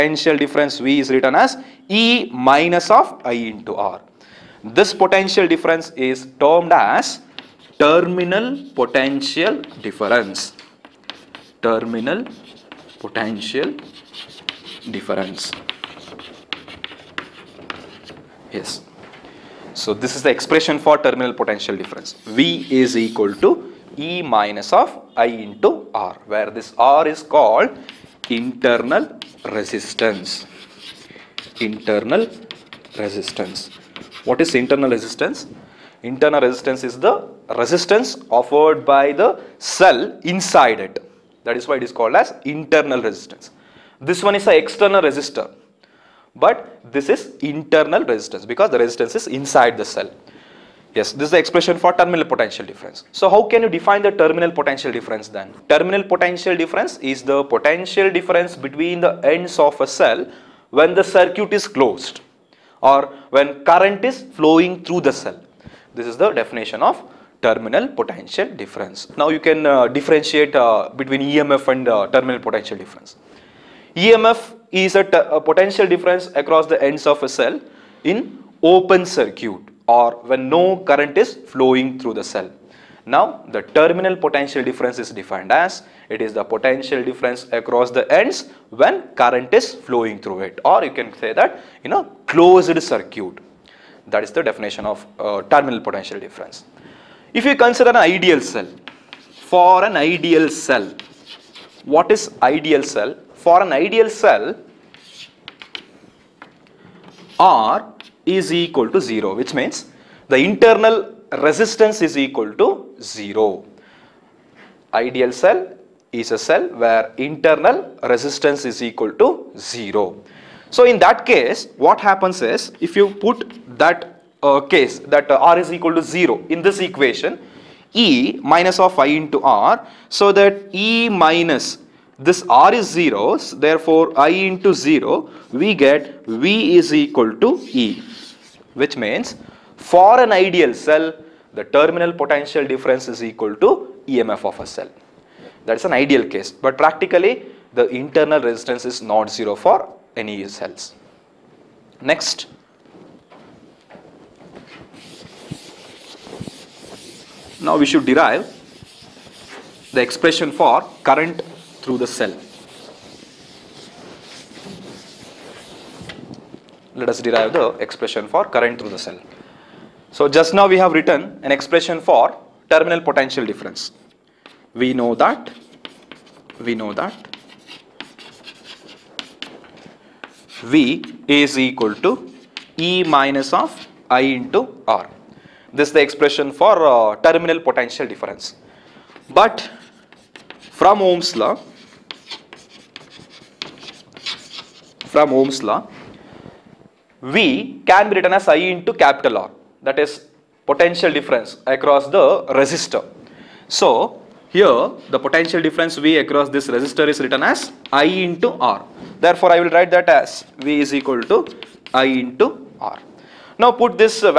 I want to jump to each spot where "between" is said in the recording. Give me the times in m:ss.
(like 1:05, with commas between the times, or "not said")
0:58, 1:11.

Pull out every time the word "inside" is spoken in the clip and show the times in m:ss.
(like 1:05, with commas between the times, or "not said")
0:40, 0:49.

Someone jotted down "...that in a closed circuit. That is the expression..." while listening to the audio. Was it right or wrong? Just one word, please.
wrong.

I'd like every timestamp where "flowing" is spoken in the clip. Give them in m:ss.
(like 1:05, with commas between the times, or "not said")
1:04, 1:21, 1:29.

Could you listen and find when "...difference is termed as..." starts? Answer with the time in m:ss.
0:05.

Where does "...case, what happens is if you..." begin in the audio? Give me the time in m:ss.
2:01.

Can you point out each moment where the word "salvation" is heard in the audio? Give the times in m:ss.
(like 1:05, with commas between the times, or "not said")
not said.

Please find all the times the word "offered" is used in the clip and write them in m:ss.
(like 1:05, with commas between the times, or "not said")
0:38.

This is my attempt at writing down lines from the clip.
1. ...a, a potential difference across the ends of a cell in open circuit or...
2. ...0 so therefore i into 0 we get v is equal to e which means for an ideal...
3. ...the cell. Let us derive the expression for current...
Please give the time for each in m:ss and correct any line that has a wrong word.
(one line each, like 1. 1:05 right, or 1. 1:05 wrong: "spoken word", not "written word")
1. 1:14 right
2. 2:12 right
3. 2:41 right.